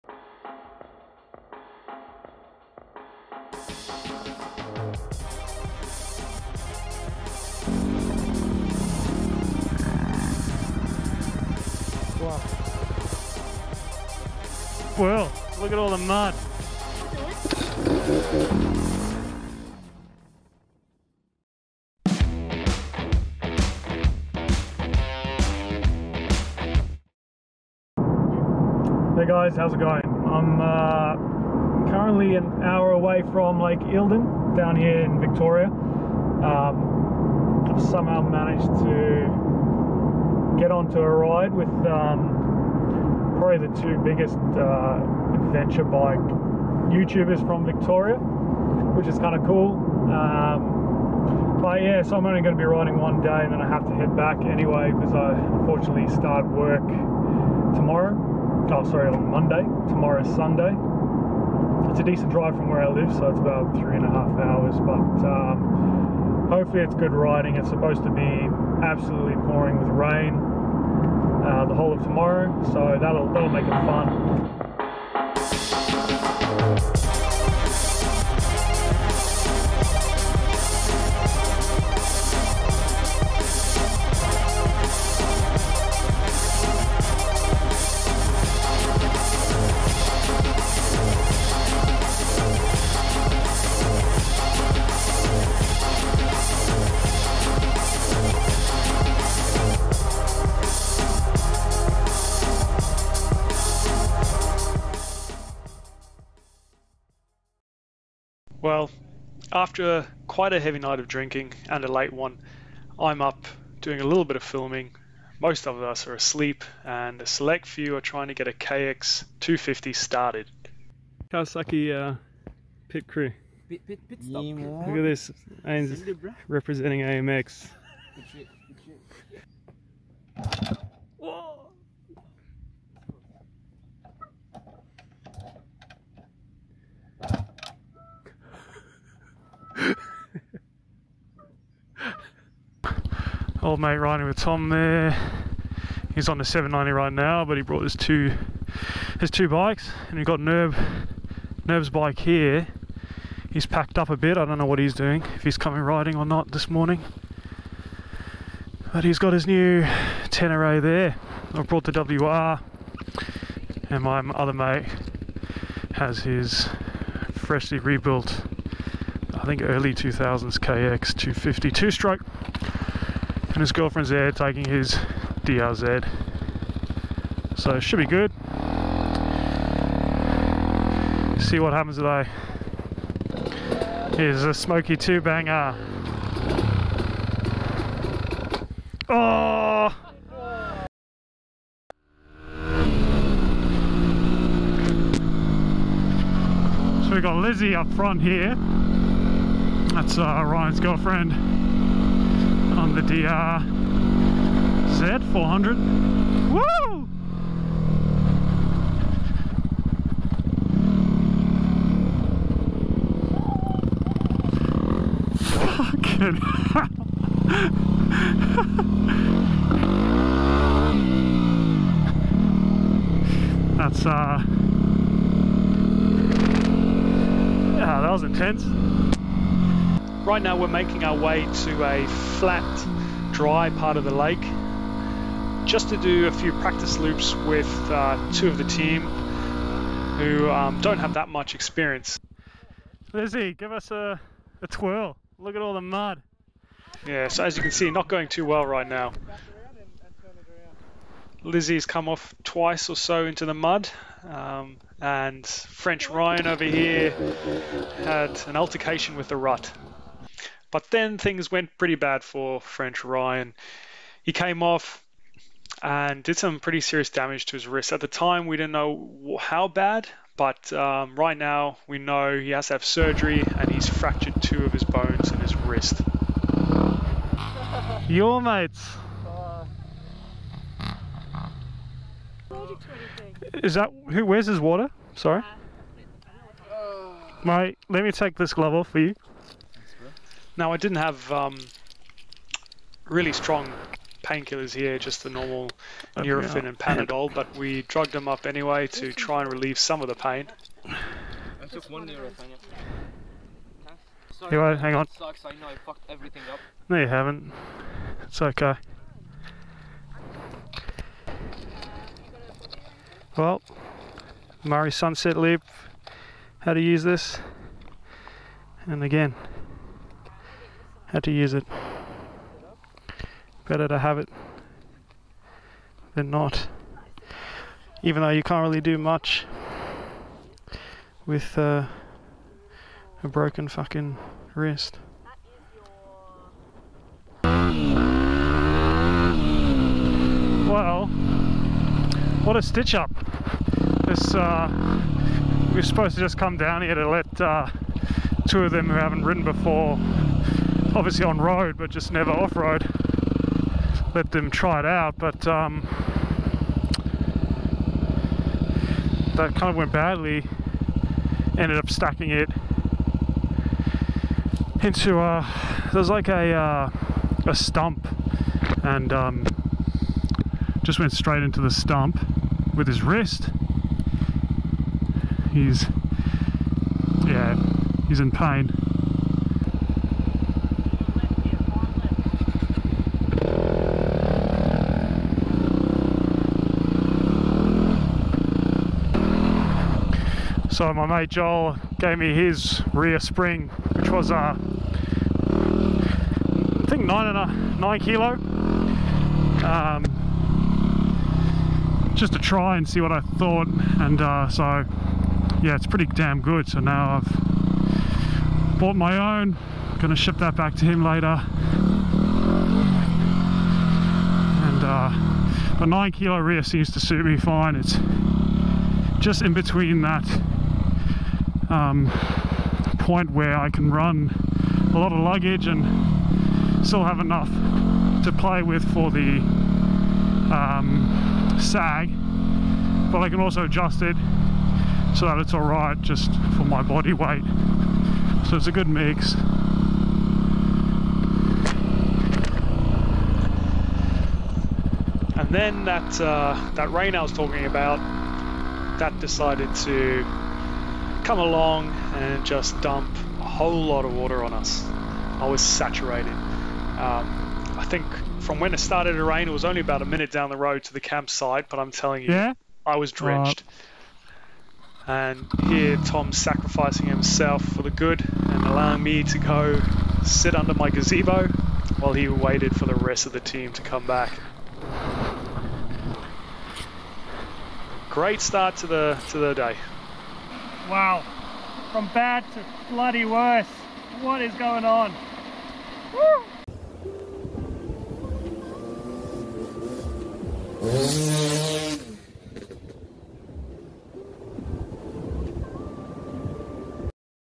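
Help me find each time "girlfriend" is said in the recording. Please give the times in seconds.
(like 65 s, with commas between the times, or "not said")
173 s, 200 s.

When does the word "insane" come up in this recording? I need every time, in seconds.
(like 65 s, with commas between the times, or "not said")
not said.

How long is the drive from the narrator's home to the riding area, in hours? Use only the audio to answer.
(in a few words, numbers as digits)
3.5 hours.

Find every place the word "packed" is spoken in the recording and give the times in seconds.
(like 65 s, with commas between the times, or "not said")
153 s.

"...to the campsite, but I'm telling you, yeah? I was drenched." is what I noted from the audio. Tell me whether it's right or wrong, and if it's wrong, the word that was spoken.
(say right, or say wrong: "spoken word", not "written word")
right.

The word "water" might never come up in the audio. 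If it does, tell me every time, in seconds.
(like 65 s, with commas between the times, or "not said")
284 s, 454 s.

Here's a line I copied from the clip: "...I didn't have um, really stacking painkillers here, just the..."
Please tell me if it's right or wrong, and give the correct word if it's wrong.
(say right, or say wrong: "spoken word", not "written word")
wrong: "strong", not "stacking".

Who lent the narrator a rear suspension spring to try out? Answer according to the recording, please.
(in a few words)
Joel.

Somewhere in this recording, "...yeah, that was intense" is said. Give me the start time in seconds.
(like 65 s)
227 s.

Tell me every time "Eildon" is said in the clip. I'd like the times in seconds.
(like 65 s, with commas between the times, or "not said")
33 s.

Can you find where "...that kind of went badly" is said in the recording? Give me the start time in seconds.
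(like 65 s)
359 s.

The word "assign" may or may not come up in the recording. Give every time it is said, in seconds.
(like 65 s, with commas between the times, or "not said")
not said.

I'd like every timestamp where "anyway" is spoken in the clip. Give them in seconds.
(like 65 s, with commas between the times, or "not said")
54 s, 298 s.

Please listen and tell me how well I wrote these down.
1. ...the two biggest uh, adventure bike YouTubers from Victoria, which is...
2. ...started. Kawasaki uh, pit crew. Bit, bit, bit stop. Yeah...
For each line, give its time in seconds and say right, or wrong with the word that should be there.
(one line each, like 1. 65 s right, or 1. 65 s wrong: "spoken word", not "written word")
1. 43 s right
2. 119 s right.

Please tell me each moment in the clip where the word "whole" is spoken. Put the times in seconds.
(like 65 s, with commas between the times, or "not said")
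71 s, 453 s.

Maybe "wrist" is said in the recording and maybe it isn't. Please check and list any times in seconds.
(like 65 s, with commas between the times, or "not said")
267 s, 275 s, 334 s, 373 s.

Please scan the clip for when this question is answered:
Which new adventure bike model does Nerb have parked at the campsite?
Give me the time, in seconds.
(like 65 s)
160 s.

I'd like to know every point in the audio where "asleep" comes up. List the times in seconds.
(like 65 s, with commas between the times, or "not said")
116 s.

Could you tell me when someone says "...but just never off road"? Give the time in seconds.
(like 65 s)
351 s.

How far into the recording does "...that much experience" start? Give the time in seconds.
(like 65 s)
241 s.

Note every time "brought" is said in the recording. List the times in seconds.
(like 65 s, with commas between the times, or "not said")
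147 s, 161 s.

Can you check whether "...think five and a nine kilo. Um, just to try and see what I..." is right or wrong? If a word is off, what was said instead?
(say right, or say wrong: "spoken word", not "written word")
wrong: "nine", not "five".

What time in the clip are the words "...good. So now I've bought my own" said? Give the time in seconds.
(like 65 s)
406 s.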